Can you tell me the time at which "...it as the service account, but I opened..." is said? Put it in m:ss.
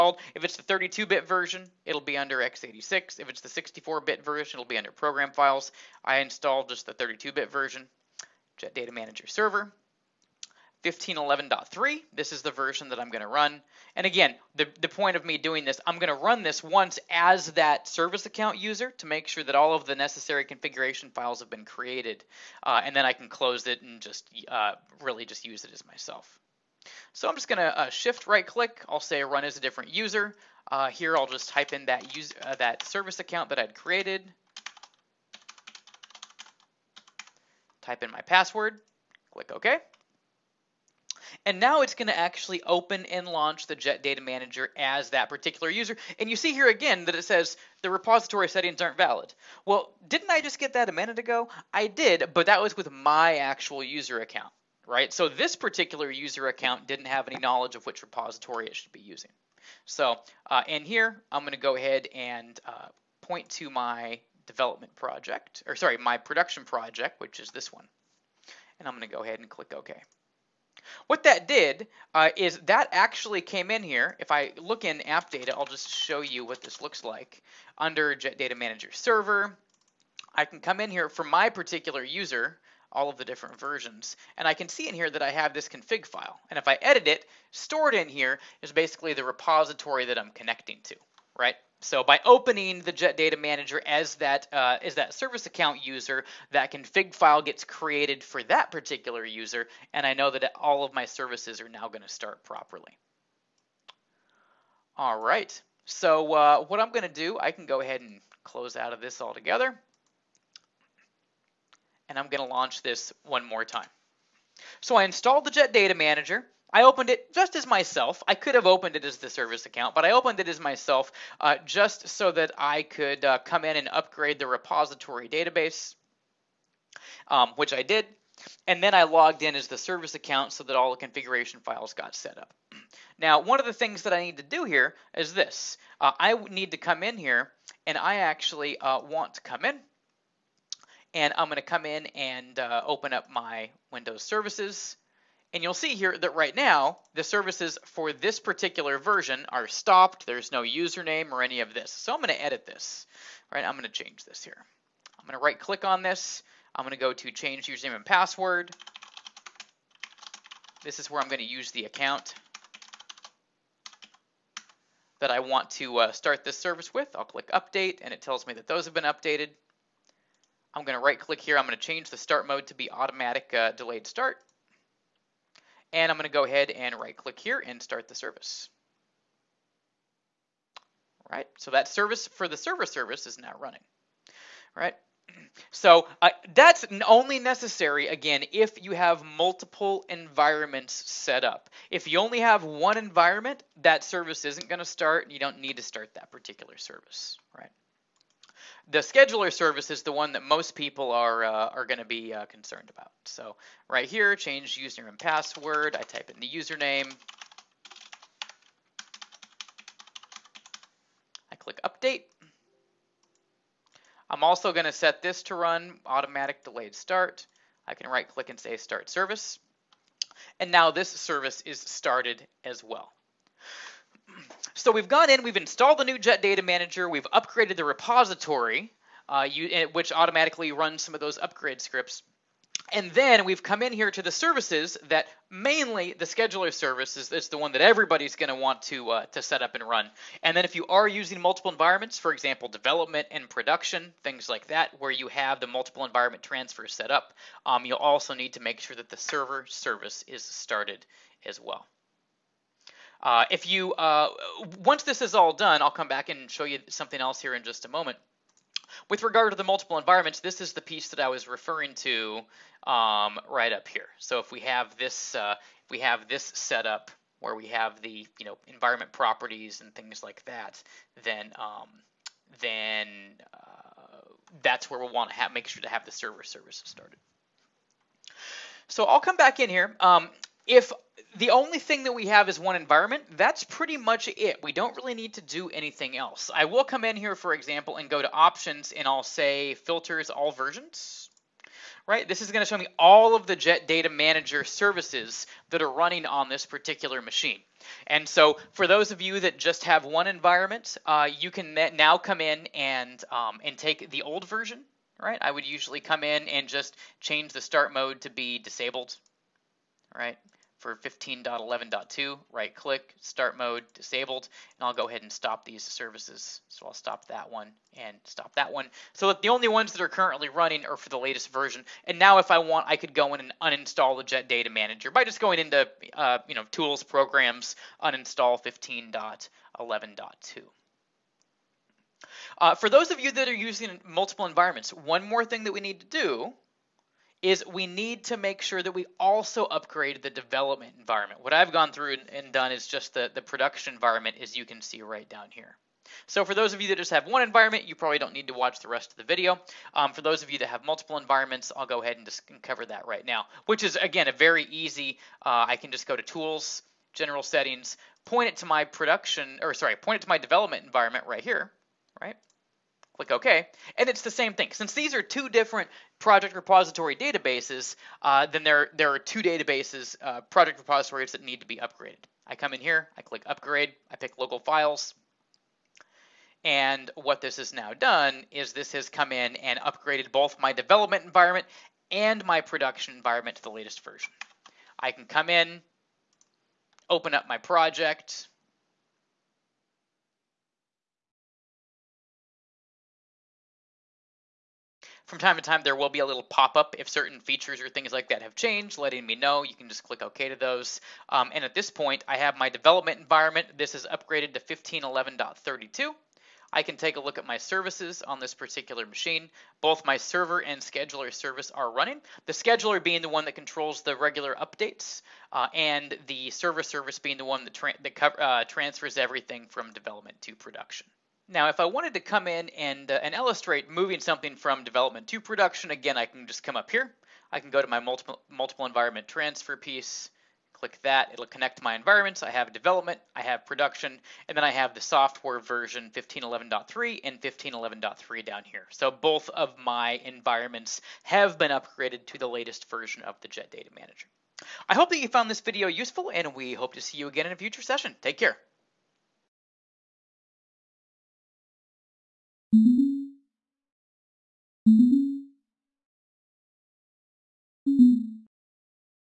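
1:58.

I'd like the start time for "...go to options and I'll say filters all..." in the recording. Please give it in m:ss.
4:48.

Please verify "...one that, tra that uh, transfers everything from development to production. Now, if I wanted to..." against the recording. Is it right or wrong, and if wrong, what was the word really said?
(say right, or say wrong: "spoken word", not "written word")
right.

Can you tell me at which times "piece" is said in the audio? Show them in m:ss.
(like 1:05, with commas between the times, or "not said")
4:20, 7:09.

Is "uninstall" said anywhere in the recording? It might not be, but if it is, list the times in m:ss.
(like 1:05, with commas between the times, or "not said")
5:23, 5:28.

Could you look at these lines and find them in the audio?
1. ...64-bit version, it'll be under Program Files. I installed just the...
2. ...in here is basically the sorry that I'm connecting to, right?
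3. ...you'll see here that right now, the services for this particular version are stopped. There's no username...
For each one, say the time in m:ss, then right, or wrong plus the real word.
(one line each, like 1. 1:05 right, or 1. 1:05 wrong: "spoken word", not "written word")
1. 0:03 right
2. 1:27 wrong: "repository", not "sorry"
3. 2:25 right.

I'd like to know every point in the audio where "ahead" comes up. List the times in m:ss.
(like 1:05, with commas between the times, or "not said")
1:01, 1:09, 1:47, 2:56, 5:15, 5:52.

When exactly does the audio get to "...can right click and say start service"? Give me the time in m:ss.
3:37.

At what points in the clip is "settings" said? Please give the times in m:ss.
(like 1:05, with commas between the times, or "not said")
0:48, 5:57.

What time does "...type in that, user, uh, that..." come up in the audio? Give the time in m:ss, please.
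0:31.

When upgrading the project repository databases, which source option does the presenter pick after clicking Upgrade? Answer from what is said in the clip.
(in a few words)
Local Files.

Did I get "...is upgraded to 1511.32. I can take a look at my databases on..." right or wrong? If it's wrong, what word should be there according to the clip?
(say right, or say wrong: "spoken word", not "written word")
wrong: "services", not "databases".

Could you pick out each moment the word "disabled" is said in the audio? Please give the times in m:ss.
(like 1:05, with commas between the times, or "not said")
5:08, 5:13.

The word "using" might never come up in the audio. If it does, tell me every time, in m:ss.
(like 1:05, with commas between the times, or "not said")
0:58, 4:01, 5:33.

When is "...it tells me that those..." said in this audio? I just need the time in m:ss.
2:48.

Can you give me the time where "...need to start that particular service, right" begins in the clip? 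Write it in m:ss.
3:15.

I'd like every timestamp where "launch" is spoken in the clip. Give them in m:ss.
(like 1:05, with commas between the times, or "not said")
0:43, 1:52.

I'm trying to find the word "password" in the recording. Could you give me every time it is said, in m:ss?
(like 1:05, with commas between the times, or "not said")
0:38, 2:38, 3:25.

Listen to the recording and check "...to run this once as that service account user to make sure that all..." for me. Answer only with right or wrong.
right.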